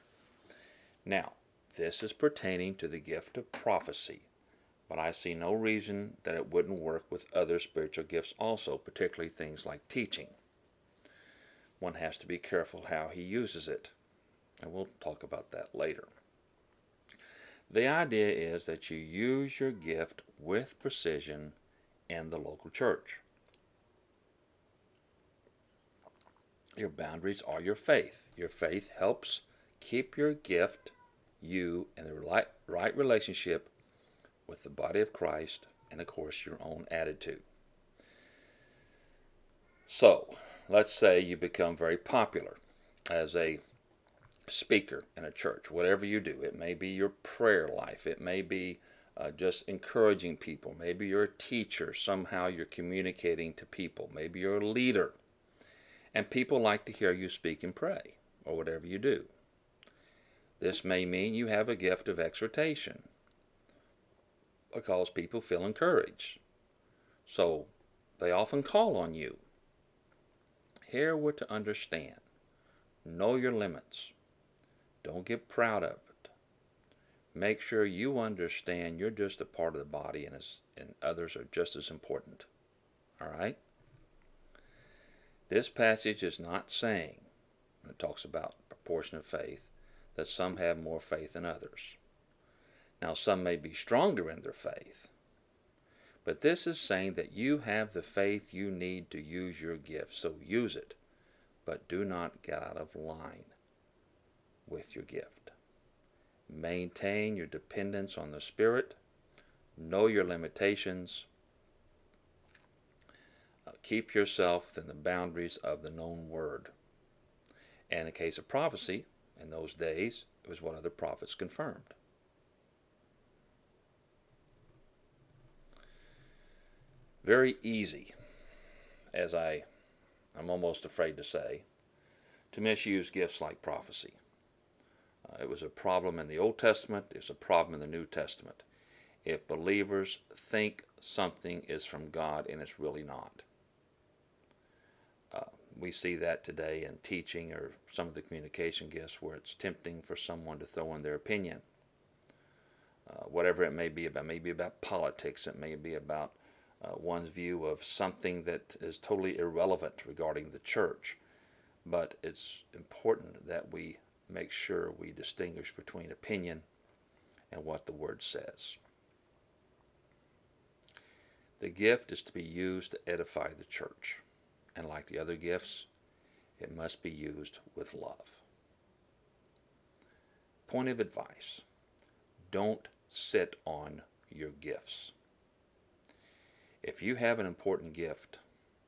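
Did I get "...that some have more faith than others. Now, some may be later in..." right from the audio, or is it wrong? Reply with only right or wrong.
wrong.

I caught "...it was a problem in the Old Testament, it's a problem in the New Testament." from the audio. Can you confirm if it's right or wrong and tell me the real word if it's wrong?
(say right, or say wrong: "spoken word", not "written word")
right.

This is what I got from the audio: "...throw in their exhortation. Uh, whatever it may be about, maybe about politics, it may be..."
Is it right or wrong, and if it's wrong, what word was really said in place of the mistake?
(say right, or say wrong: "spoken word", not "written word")
wrong: "opinion", not "exhortation".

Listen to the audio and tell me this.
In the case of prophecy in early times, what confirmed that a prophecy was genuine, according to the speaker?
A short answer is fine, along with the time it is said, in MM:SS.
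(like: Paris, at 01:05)
Other prophets, at 02:00.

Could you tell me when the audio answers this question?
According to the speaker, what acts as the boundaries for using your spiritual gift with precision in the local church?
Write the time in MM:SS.
00:26.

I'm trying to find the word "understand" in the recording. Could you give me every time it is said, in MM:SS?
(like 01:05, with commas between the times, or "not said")
01:11, 01:18.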